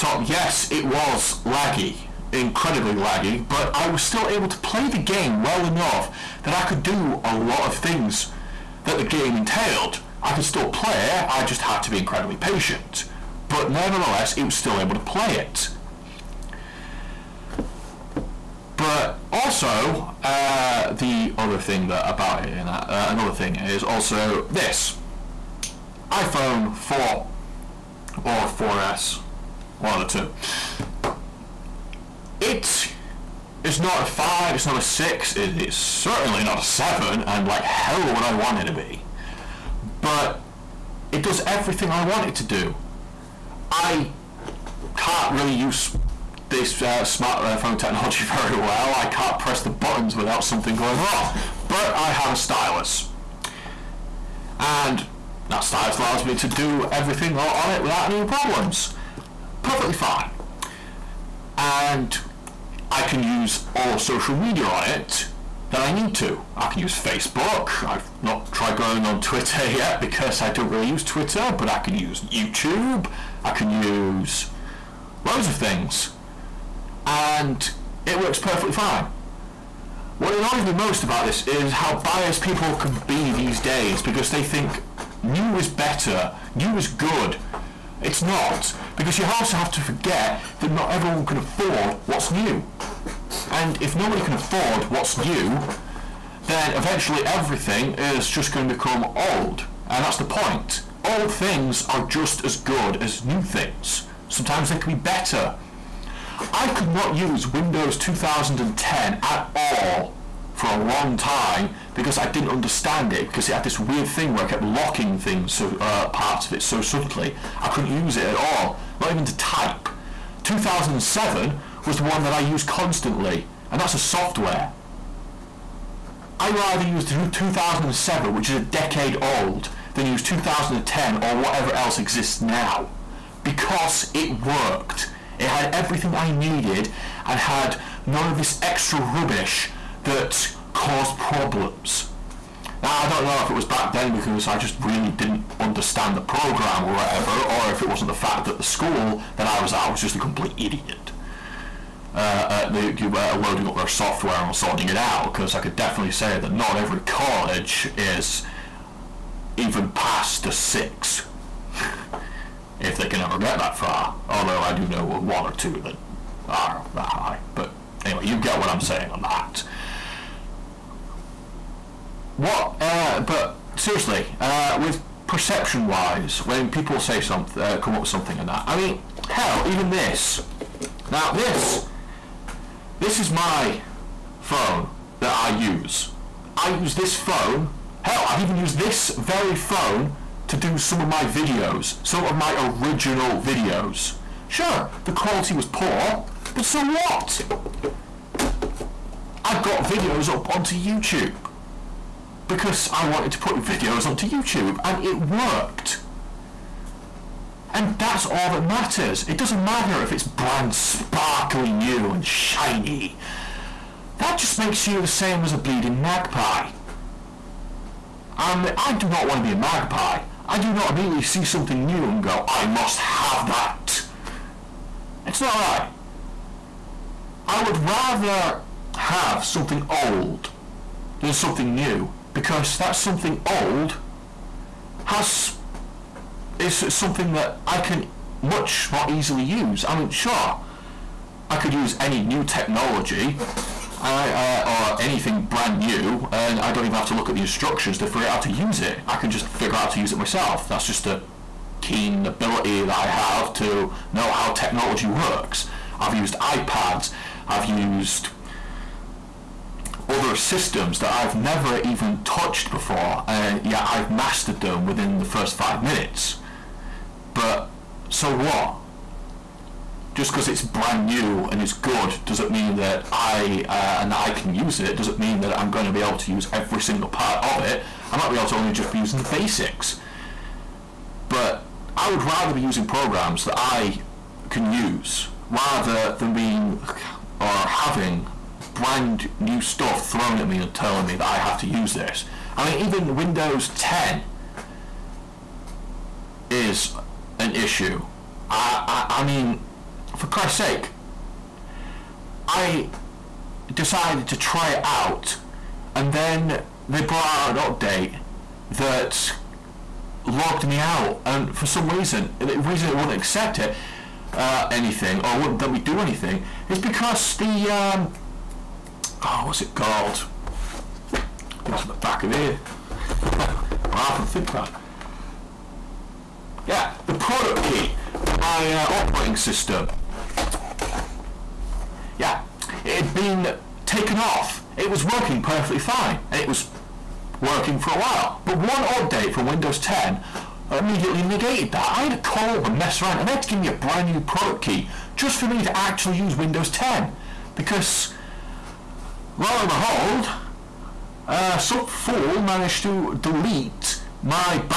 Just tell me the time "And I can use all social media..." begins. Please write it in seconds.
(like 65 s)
61 s.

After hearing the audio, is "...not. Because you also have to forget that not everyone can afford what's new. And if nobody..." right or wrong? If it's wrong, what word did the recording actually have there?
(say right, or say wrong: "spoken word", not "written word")
right.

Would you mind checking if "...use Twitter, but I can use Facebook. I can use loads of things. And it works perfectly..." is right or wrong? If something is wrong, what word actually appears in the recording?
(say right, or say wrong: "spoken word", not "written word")
wrong: "YouTube", not "Facebook".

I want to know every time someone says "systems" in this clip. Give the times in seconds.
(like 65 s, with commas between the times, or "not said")
260 s, 329 s.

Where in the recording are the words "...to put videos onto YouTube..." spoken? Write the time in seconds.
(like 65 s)
203 s.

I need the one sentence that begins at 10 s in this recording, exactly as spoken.
I could still play I just had to be incredibly patient.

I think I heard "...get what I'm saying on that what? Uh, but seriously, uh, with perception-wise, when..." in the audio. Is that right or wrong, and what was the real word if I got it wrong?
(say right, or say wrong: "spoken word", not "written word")
right.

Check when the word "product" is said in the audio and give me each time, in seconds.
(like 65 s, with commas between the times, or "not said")
327 s, 344 s.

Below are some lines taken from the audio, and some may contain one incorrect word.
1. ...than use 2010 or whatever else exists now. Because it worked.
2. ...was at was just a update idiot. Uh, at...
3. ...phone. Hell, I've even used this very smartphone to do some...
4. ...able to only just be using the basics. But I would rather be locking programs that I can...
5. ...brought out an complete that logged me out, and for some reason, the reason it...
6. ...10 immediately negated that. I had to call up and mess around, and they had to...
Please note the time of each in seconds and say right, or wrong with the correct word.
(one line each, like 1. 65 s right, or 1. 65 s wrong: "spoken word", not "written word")
1. 129 s right
2. 149 s wrong: "complete", not "update"
3. 187 s wrong: "phone", not "smartphone"
4. 278 s wrong: "using", not "locking"
5. 307 s wrong: "update", not "complete"
6. 339 s right.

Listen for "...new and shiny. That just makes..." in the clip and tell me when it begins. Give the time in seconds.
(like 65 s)
211 s.